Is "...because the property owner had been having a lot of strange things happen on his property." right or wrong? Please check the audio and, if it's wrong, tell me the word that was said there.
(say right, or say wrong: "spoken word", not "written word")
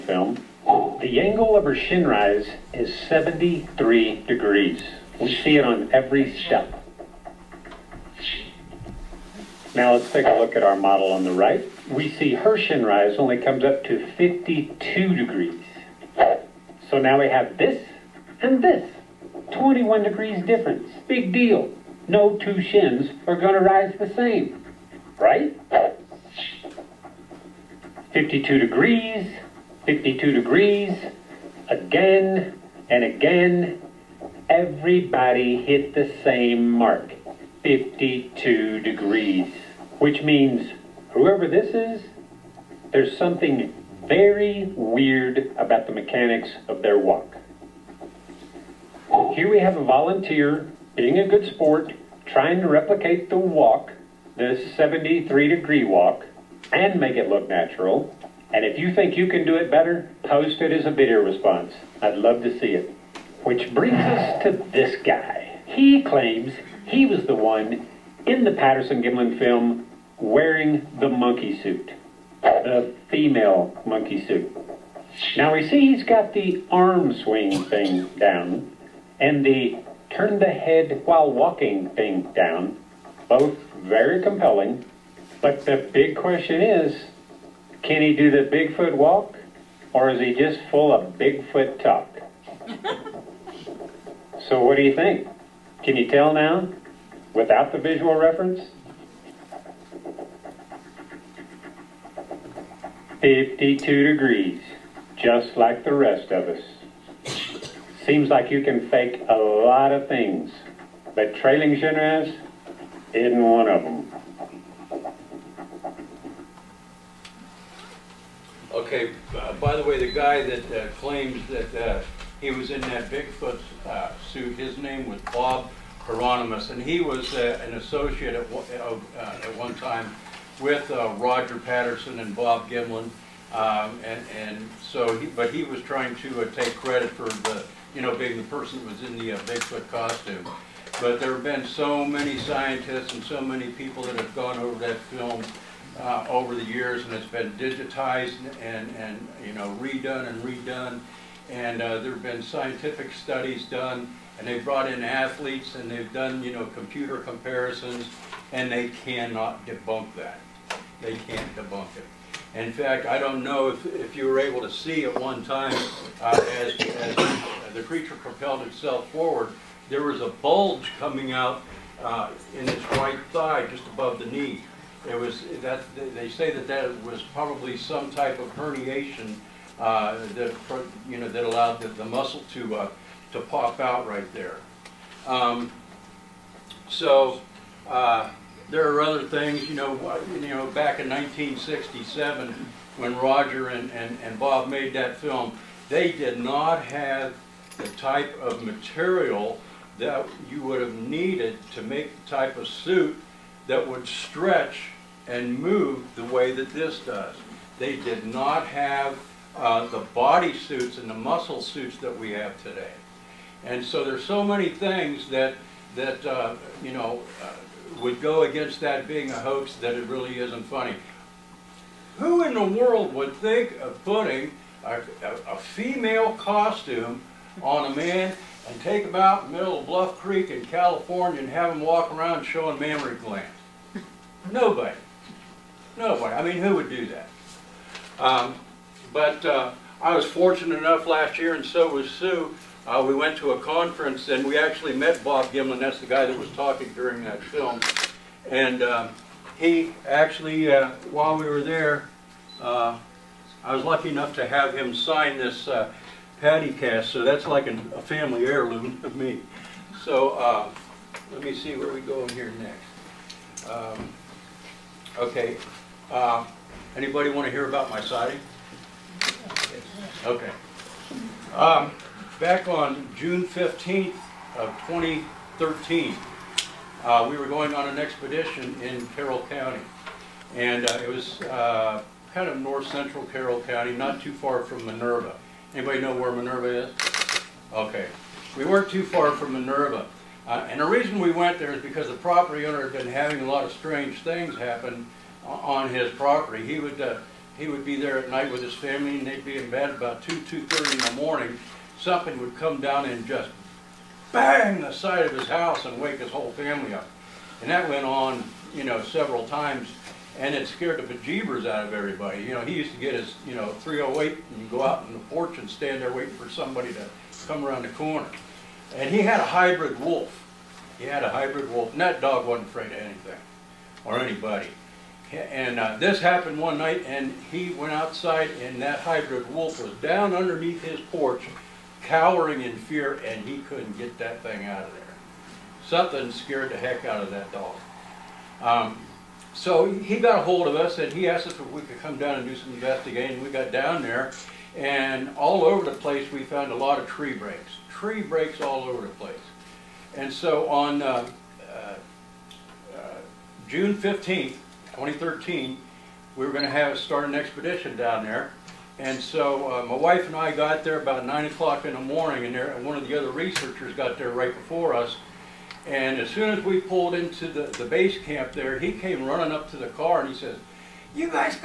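right.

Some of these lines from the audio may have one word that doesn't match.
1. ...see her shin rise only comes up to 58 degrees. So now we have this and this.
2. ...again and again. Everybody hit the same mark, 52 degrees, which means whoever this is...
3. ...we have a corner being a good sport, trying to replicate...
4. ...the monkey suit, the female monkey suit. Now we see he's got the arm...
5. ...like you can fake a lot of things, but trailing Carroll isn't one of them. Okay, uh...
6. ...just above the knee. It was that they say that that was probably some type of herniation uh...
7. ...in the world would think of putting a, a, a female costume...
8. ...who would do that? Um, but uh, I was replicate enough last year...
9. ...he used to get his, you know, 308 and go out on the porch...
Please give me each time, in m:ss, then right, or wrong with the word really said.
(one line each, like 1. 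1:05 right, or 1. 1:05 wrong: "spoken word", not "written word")
1. 0:12 wrong: "52", not "58"
2. 0:31 right
3. 0:49 wrong: "volunteer", not "corner"
4. 1:10 right
5. 1:48 wrong: "Generaz", not "Carroll"
6. 2:53 right
7. 3:42 right
8. 3:56 wrong: "fortunate", not "replicate"
9. 5:12 right.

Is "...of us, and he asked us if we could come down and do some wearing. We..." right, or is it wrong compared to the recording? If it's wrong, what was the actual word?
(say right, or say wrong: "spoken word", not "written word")
wrong: "investigating", not "wearing".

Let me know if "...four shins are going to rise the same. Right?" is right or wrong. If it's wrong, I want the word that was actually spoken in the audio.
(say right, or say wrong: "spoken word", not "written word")
wrong: "two", not "four".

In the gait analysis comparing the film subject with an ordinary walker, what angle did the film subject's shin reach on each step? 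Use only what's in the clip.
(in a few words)
73 degrees.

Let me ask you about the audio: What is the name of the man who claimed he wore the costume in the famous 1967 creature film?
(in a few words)
Bob Hieronymus.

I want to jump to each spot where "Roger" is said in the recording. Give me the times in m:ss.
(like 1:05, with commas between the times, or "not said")
2:11, 3:13.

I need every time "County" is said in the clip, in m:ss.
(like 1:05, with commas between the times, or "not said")
4:39, 4:43.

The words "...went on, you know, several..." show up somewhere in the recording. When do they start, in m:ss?
5:07.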